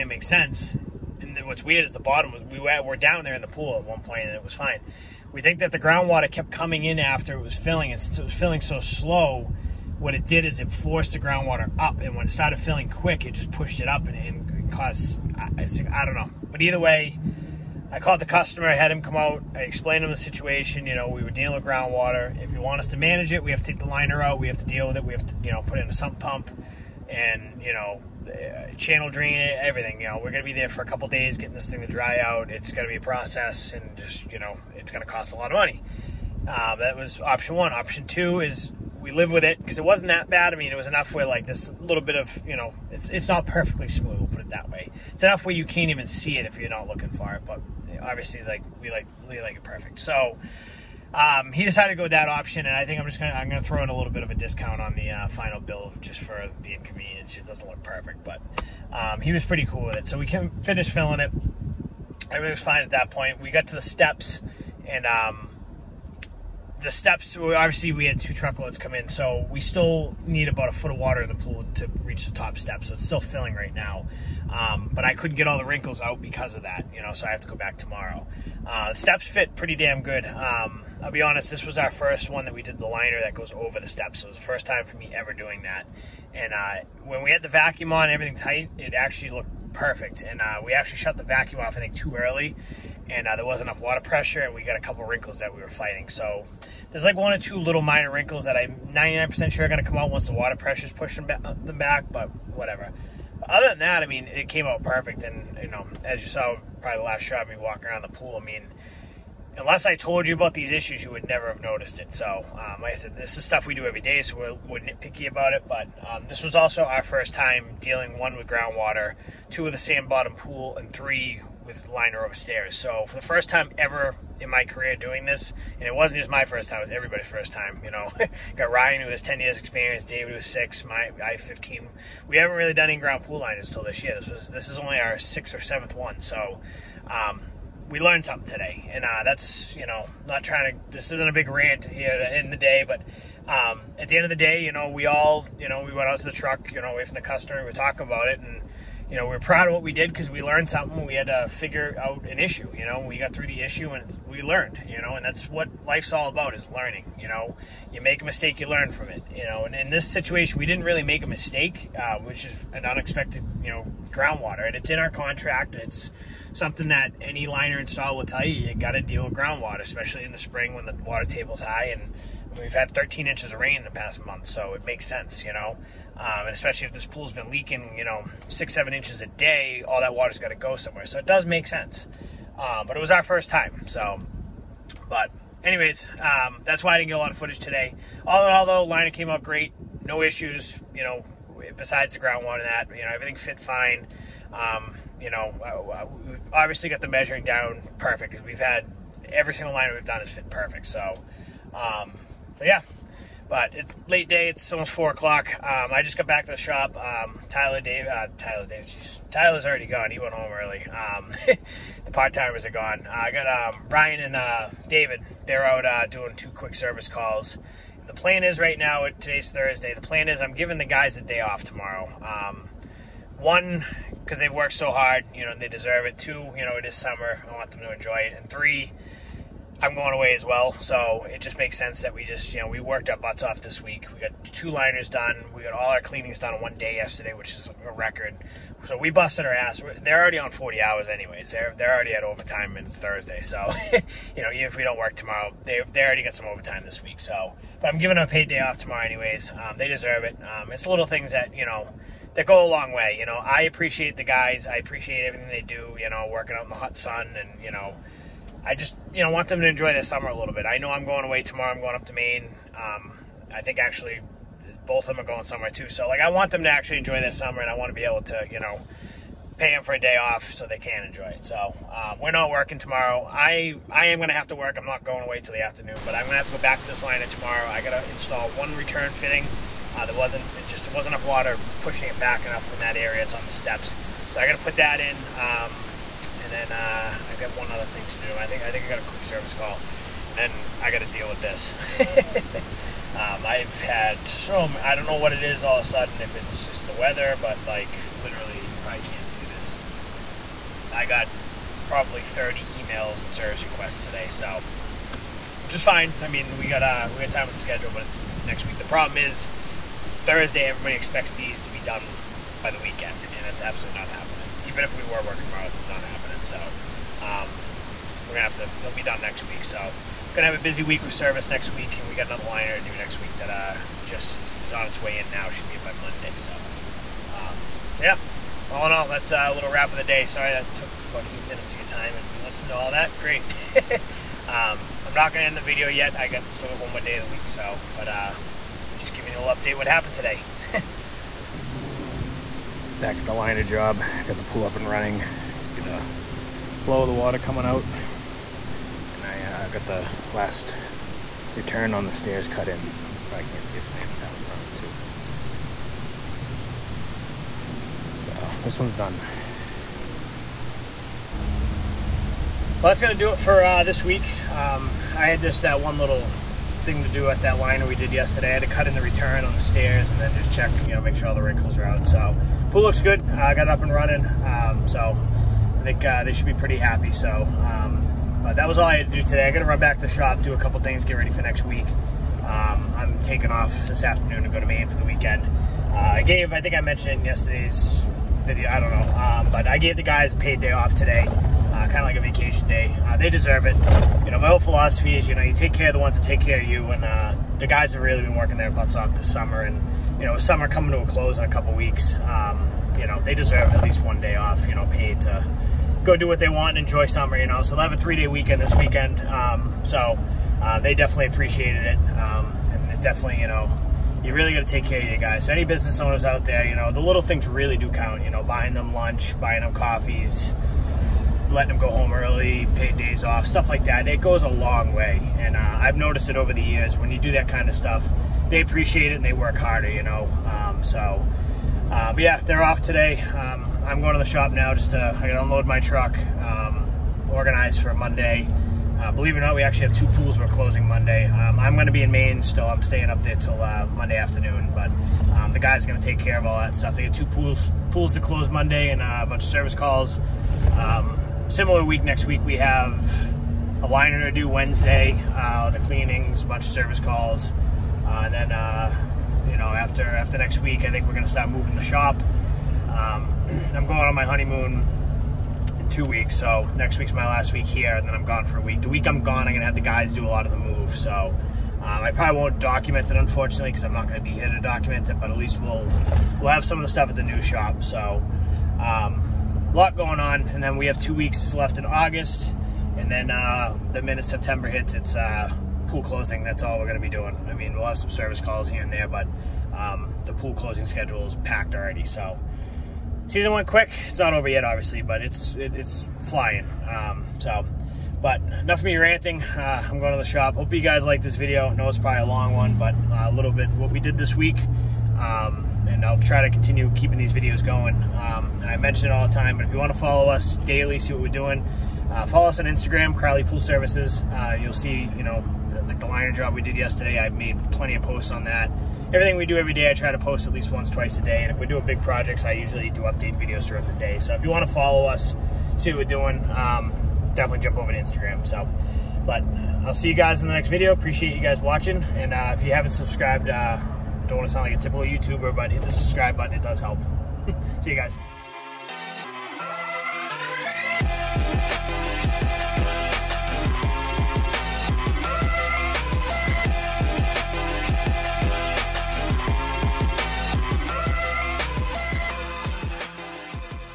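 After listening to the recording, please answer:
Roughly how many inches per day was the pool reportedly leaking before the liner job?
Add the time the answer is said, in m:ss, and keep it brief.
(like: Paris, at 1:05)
6 or 7, at 2:58.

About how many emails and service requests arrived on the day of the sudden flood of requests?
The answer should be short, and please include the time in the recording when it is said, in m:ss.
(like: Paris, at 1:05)
30, at 5:02.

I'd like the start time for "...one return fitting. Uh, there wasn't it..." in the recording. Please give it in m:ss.
4:38.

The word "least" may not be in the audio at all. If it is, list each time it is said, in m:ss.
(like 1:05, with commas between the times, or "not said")
6:43, 7:55, 8:40.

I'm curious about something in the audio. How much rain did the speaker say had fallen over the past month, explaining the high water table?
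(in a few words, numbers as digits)
13 inches.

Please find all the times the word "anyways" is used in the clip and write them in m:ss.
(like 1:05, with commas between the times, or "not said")
3:05, 4:01, 4:09.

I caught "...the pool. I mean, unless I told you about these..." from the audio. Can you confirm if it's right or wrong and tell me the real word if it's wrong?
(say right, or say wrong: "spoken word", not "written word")
right.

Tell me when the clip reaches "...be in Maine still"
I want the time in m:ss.
7:21.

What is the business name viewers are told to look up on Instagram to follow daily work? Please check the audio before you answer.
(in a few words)
Crowley Pool Services.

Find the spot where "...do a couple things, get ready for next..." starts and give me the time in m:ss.
6:20.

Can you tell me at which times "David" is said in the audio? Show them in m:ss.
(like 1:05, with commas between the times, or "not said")
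2:10, 3:34.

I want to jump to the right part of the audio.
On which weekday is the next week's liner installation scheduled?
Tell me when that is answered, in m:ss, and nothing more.
7:34.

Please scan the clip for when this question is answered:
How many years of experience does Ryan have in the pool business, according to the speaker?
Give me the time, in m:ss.
2:09.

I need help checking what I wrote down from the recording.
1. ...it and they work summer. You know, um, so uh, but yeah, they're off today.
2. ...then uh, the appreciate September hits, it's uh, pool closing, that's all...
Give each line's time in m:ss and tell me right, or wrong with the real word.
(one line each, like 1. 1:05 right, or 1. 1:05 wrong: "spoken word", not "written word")
1. 7:09 wrong: "harder", not "summer"
2. 8:03 wrong: "minute", not "appreciate".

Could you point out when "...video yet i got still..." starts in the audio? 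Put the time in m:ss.
5:35.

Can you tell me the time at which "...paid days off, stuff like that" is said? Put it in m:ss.
7:02.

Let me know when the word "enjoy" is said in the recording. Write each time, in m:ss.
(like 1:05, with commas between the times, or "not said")
3:47, 4:19, 4:26, 4:31, 6:46.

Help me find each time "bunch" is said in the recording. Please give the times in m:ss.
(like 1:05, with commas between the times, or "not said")
7:29, 7:36.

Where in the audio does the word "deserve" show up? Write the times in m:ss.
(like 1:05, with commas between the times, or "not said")
3:45, 4:09, 6:33, 6:43.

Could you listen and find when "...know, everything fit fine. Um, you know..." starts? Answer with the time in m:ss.
3:13.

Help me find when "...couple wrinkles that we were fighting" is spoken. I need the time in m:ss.
1:34.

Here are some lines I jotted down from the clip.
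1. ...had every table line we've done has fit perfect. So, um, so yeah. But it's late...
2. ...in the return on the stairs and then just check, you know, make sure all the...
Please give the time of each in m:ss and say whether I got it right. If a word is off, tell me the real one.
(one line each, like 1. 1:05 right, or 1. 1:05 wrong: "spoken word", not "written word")
1. 3:18 wrong: "single", not "table"
2. 6:08 right.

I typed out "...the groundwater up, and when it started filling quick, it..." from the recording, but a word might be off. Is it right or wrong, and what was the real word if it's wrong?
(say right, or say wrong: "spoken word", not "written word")
right.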